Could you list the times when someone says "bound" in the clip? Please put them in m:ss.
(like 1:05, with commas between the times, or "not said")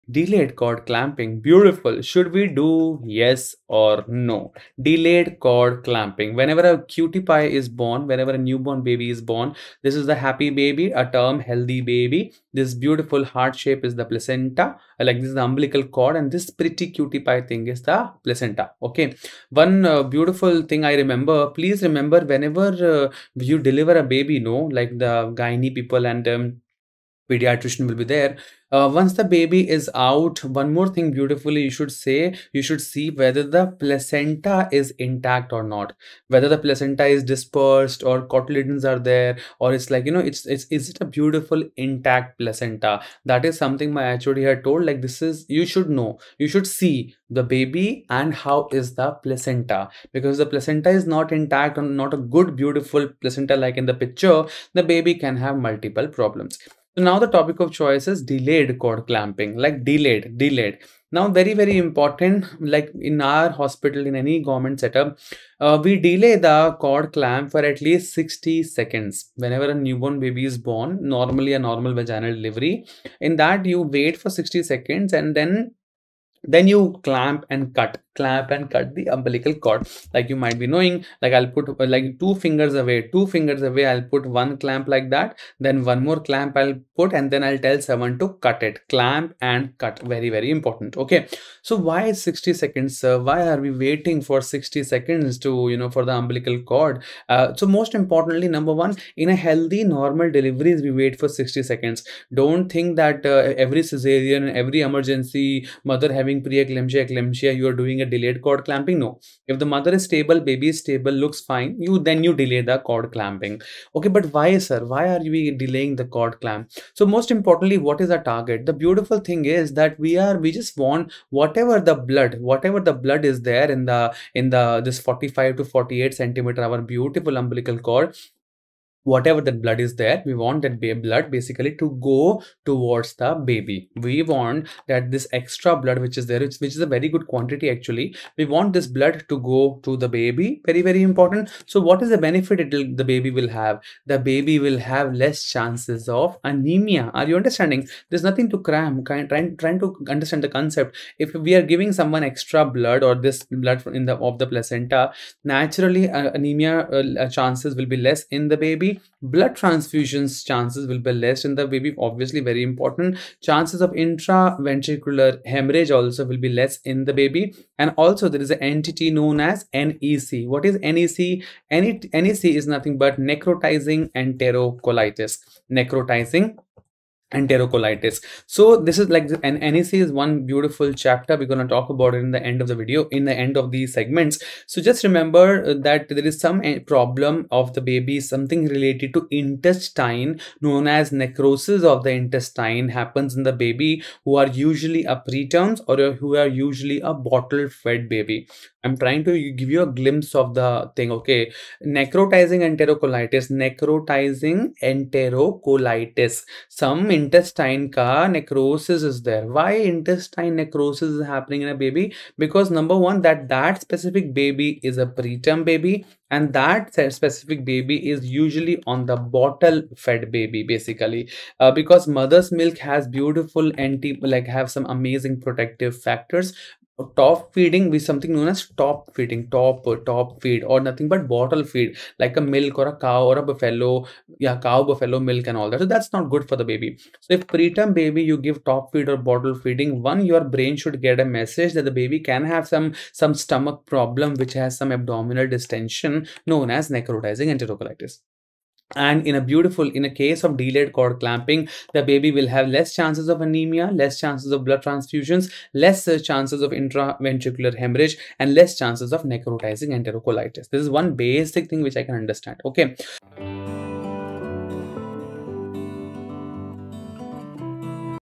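not said.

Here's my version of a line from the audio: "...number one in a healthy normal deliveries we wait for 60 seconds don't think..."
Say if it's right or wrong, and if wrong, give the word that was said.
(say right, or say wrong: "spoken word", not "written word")
right.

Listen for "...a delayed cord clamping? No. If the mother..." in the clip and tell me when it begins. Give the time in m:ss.
1:48.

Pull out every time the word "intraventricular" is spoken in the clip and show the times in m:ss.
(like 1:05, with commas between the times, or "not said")
2:43, 4:16.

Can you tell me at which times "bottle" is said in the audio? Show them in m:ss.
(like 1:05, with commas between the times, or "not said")
3:17, 3:39, 3:51, 3:59.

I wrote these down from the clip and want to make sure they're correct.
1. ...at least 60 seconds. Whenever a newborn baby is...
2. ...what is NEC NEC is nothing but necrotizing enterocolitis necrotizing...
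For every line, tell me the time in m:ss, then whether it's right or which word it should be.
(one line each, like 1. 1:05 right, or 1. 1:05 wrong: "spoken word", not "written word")
1. 1:07 right
2. 2:50 right.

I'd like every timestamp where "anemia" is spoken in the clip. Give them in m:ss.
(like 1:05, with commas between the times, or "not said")
2:26, 2:36, 4:13.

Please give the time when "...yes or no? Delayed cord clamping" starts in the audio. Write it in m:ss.
0:03.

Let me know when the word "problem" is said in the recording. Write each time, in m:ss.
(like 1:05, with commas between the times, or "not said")
0:56, 3:06, 4:03.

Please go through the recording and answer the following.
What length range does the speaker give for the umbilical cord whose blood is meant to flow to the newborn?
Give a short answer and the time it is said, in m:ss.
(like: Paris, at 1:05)
45 to 48 centimeters, at 2:04.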